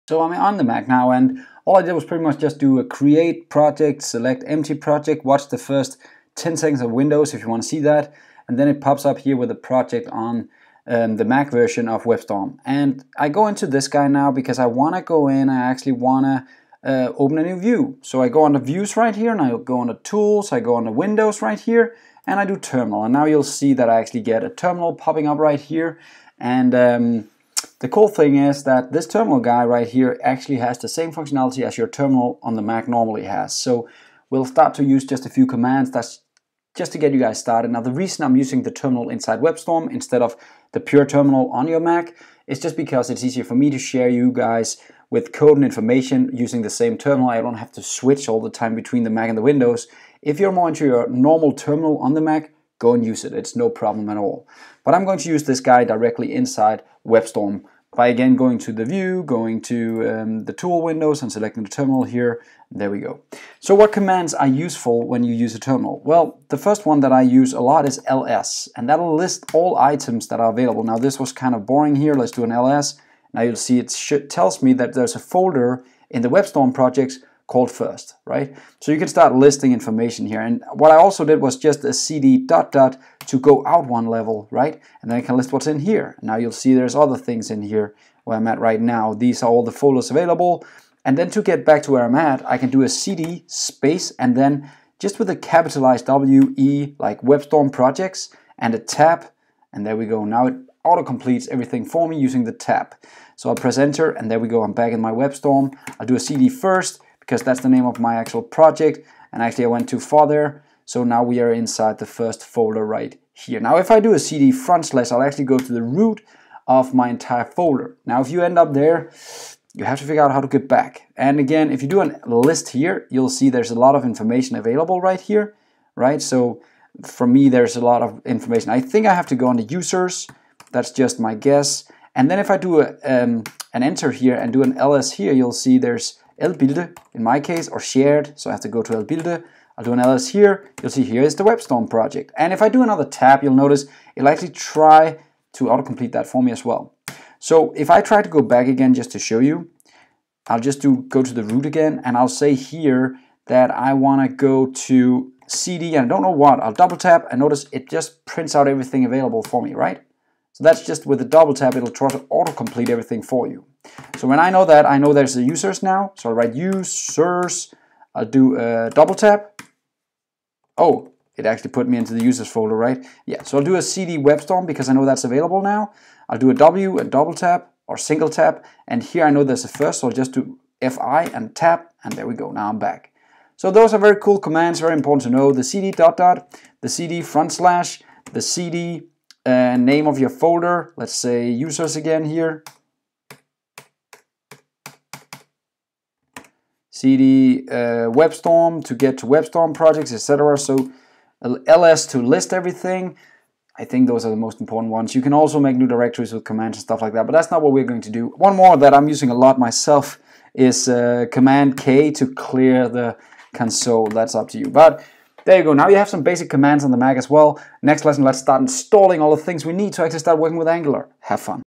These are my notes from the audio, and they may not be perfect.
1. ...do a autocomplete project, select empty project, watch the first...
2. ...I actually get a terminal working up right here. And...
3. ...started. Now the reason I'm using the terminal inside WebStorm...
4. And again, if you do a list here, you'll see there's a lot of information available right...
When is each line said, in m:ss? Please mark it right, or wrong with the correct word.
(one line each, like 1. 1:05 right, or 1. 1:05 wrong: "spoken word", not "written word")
1. 0:02 wrong: "create", not "autocomplete"
2. 0:23 wrong: "popping", not "working"
3. 0:37 right
4. 2:01 right.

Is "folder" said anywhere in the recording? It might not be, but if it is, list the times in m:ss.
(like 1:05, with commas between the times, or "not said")
1:15, 1:29, 1:52, 1:57, 2:52, 3:10.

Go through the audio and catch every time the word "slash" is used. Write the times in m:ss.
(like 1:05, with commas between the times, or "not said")
1:54, 3:07.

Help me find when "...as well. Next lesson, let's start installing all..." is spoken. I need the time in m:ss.
3:37.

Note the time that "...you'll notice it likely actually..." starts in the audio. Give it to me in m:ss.
2:23.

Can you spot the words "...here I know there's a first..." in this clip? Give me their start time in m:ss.
2:59.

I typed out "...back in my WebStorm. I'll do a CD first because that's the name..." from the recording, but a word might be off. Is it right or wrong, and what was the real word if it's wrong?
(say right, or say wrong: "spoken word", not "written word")
right.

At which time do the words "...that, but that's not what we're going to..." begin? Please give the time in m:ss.
3:27.